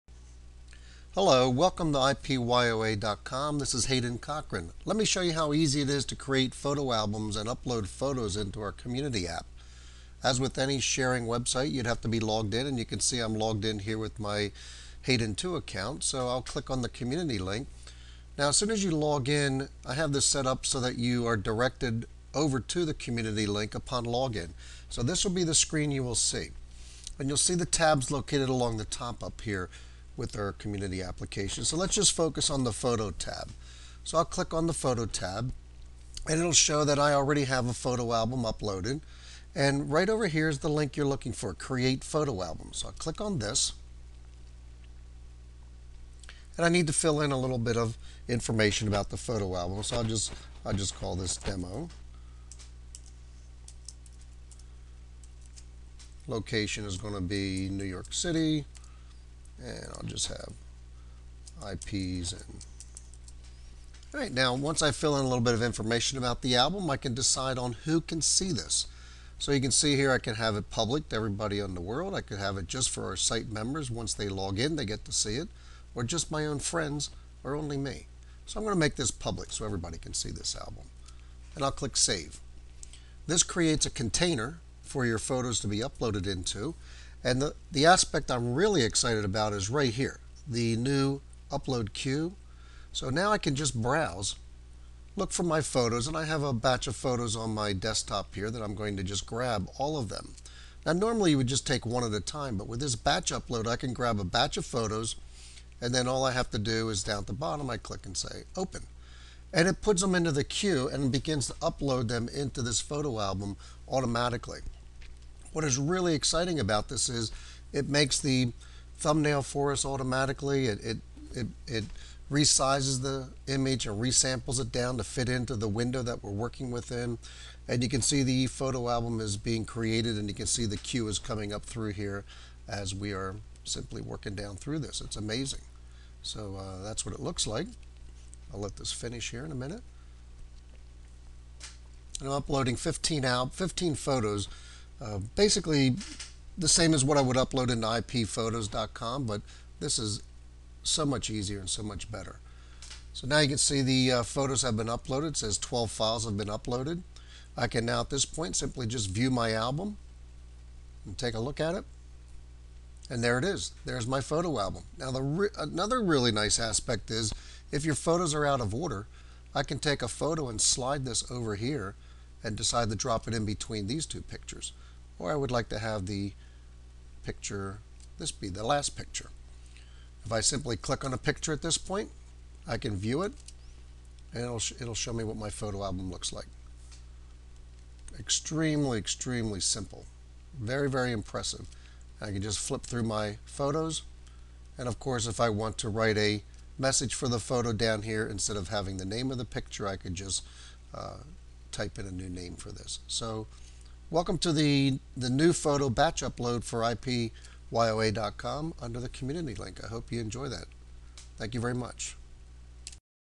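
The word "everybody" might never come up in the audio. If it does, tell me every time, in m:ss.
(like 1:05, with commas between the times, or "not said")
1:11, 1:19.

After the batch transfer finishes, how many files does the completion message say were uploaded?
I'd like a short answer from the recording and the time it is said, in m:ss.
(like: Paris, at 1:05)
12, at 2:35.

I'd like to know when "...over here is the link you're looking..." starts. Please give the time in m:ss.
0:40.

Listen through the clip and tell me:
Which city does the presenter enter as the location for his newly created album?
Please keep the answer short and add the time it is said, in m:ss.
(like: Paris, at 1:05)
New York City, at 0:57.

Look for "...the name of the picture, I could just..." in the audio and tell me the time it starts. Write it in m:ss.
3:18.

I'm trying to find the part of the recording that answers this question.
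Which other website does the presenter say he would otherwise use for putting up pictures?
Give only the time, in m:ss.
2:27.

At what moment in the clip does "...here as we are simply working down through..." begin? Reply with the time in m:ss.
2:11.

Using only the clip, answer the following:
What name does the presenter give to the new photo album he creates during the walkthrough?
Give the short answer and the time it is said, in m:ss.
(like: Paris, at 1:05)
demo, at 0:51.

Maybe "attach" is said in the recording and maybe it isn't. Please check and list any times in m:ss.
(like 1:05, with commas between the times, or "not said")
not said.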